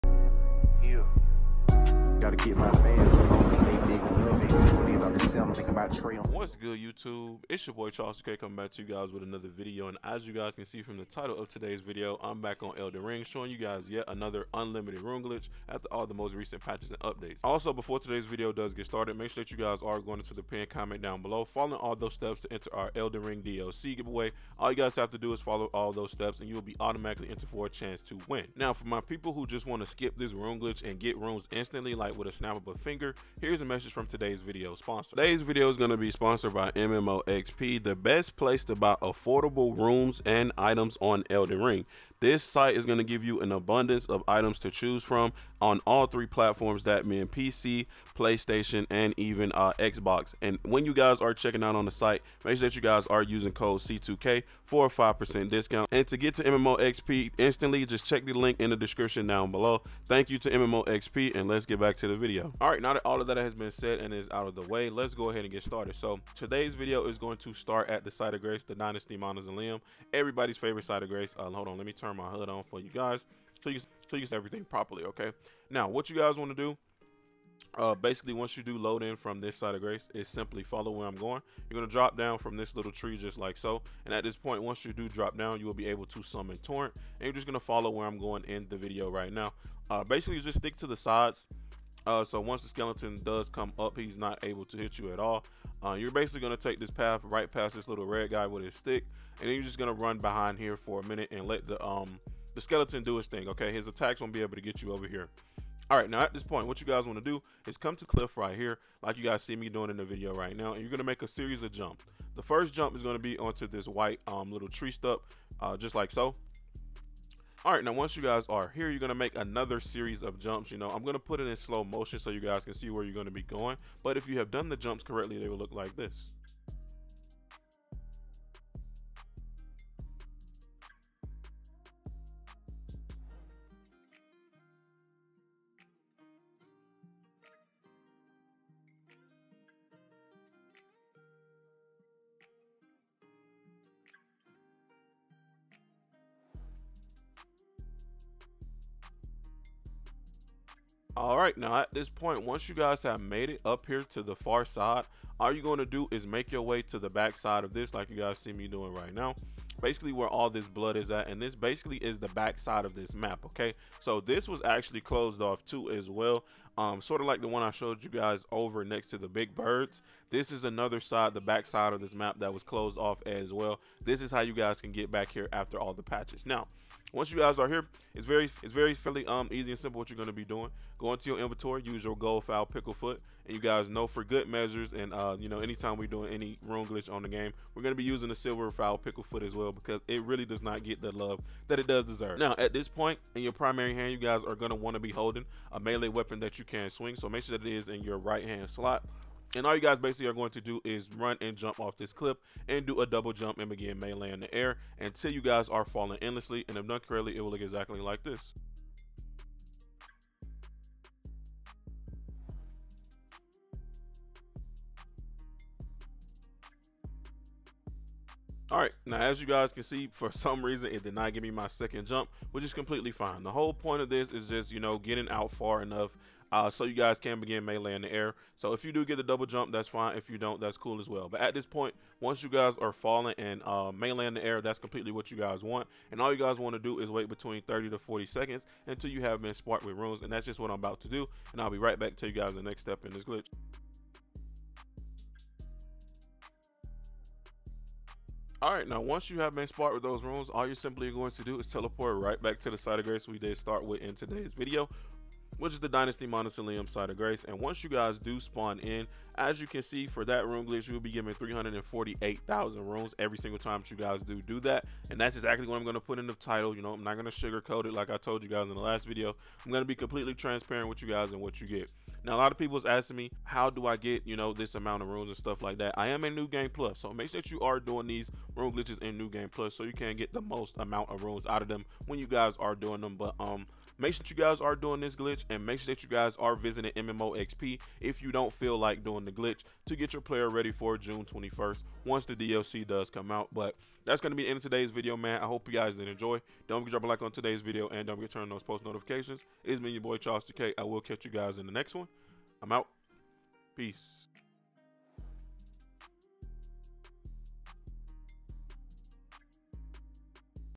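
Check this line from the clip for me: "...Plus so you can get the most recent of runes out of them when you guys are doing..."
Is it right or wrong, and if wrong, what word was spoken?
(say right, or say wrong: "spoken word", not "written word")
wrong: "amount", not "recent".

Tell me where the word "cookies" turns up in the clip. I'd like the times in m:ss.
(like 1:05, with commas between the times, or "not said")
not said.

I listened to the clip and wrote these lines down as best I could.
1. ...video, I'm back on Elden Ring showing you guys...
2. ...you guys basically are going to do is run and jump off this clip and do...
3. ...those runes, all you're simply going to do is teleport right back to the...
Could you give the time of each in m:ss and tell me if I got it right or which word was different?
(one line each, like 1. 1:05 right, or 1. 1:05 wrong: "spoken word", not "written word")
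1. 0:11 right
2. 3:19 right
3. 4:10 right.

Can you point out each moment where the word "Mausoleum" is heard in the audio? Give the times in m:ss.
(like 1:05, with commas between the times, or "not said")
1:09, 4:16.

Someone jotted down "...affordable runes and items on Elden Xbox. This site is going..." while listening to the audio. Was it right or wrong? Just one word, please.
wrong.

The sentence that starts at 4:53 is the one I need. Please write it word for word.
But that's going to be the end of today's video, man.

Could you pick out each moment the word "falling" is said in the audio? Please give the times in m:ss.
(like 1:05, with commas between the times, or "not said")
3:25, 3:52.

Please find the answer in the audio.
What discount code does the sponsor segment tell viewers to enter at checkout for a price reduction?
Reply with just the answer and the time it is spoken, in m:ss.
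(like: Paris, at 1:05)
C2K, at 0:53.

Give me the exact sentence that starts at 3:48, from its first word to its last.
So if you do get the double jump, that's fine.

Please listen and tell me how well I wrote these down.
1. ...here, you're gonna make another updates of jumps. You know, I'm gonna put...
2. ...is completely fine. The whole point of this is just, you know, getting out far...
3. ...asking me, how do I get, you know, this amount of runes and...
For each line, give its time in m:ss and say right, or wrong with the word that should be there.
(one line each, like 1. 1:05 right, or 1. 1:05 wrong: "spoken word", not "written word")
1. 1:58 wrong: "series", not "updates"
2. 3:42 right
3. 4:32 right.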